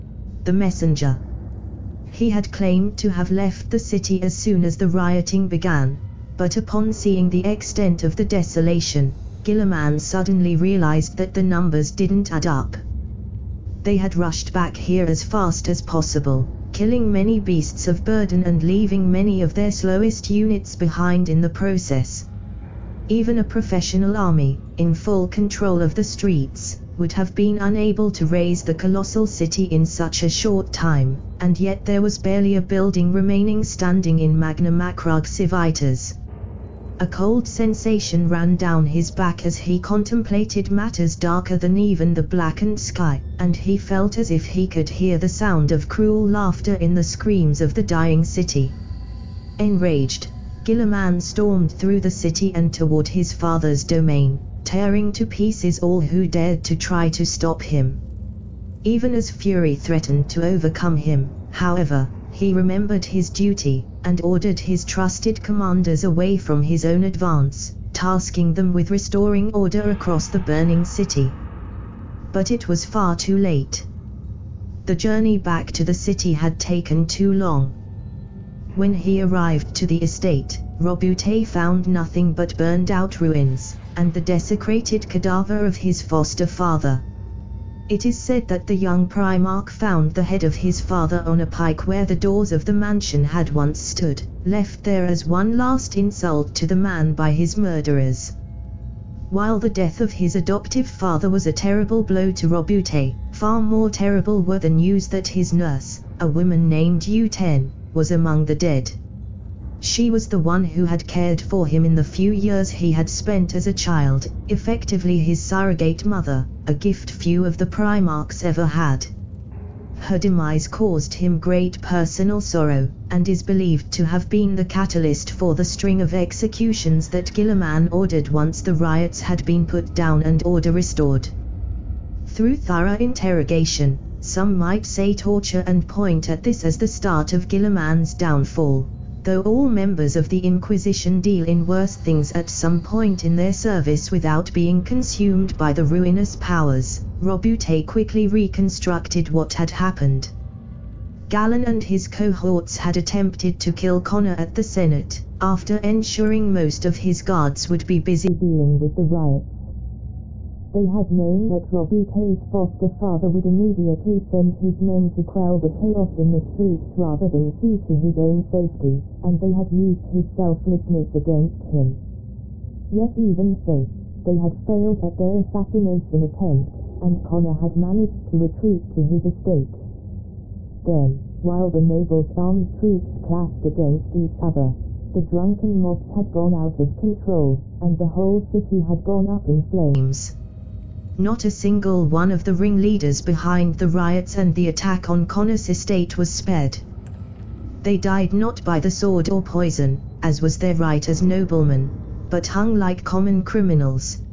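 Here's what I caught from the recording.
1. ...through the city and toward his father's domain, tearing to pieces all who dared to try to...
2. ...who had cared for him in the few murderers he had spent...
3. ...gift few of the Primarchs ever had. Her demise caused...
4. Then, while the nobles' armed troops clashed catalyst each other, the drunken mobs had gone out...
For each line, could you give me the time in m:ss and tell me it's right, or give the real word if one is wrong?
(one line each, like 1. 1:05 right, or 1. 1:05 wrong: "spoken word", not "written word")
1. 0:51 right
2. 1:50 wrong: "years", not "murderers"
3. 1:56 right
4. 3:00 wrong: "against", not "catalyst".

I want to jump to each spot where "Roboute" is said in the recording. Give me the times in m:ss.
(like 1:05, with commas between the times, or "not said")
1:20, 1:42, 2:27, 2:41.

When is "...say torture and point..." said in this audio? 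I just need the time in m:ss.
2:14.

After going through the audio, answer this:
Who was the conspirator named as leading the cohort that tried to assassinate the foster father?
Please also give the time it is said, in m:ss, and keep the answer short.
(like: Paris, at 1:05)
Galen, at 2:31.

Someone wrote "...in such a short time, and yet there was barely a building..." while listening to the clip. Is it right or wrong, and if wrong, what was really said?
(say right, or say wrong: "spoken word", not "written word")
right.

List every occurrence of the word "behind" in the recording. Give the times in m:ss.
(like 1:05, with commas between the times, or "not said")
0:20, 3:13.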